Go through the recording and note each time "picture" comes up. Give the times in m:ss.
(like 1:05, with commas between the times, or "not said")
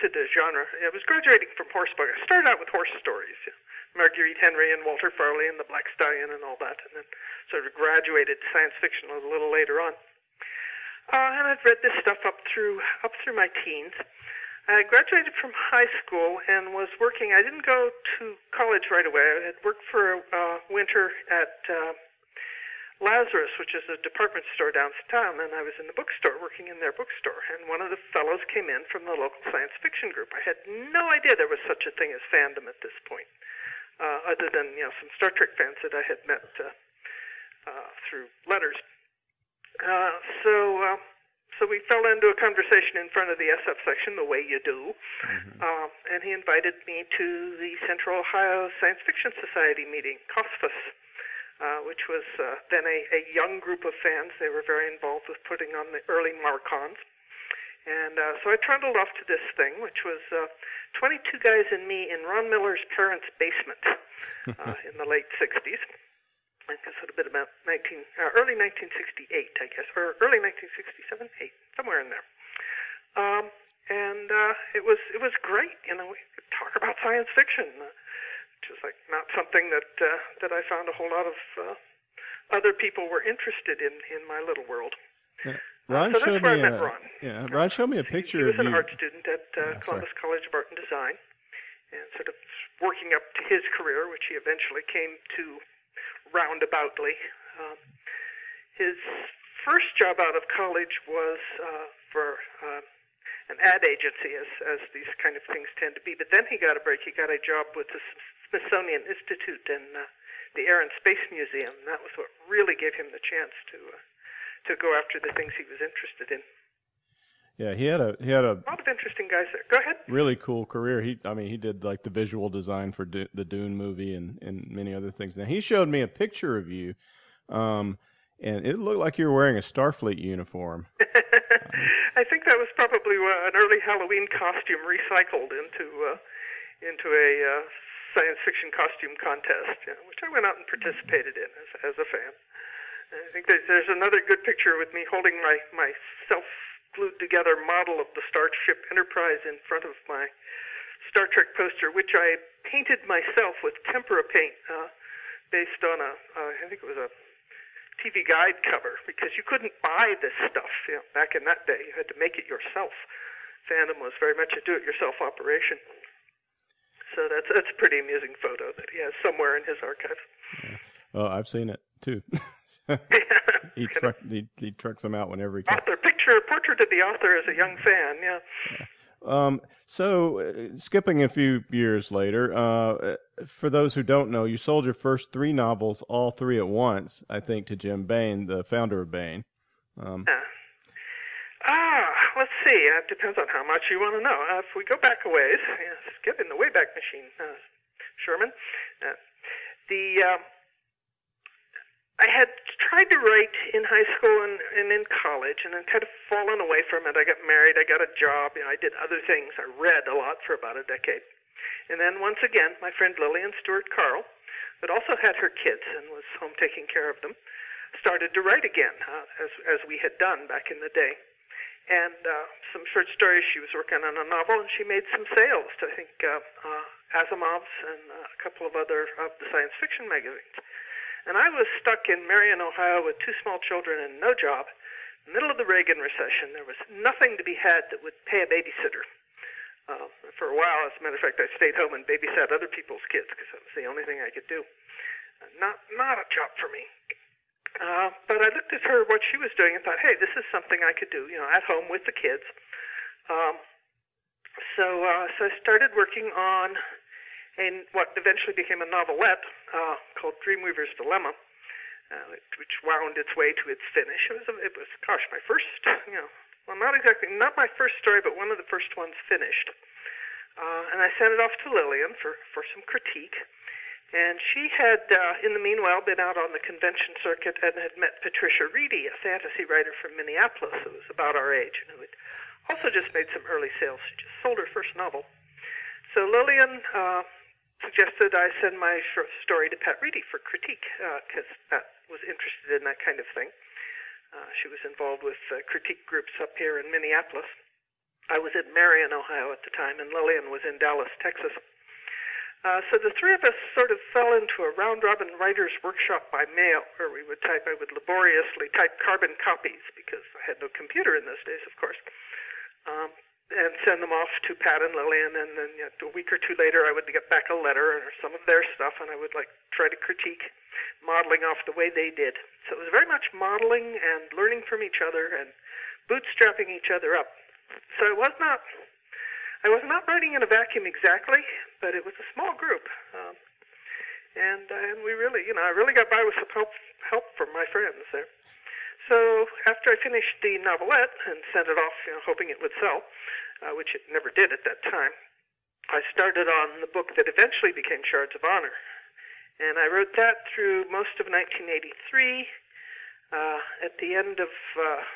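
1:28, 2:06, 2:24, 2:55.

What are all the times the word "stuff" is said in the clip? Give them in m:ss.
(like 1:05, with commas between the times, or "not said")
0:12, 2:40, 5:18.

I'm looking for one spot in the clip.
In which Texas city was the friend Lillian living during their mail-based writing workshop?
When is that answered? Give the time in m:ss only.
5:00.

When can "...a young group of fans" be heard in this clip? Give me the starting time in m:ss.
0:53.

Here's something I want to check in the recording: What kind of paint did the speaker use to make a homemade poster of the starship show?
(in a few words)
Tempera.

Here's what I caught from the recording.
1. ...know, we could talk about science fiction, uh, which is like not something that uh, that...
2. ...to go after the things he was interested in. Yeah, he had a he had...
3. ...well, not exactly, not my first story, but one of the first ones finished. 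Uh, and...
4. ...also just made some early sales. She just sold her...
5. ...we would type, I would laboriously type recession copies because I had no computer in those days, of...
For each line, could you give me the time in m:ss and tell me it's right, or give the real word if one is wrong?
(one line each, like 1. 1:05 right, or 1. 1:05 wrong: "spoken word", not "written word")
1. 1:15 right
2. 1:54 right
3. 4:26 right
4. 4:42 right
5. 5:07 wrong: "carbon", not "recession".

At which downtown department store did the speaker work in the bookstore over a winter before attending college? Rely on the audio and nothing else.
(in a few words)
Lazarus.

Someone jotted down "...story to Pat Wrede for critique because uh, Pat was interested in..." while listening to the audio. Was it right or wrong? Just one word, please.
right.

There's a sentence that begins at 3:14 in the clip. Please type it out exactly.
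Uh, if we go back a ways, get in the Wayback Machine, uh, Sherman.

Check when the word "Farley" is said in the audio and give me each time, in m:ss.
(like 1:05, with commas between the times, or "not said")
0:05.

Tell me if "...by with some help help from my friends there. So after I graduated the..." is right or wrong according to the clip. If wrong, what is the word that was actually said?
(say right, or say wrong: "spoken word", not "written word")
wrong: "finished", not "graduated".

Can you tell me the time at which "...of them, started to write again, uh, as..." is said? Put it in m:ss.
3:37.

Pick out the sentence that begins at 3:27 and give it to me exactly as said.
I got married, I got a job, you know, I did other things.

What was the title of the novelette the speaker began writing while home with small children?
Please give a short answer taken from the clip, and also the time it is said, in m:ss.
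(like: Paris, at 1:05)
Dreamweaver's Dilemma, at 4:20.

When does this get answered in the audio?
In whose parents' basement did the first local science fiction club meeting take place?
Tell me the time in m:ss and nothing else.
1:02.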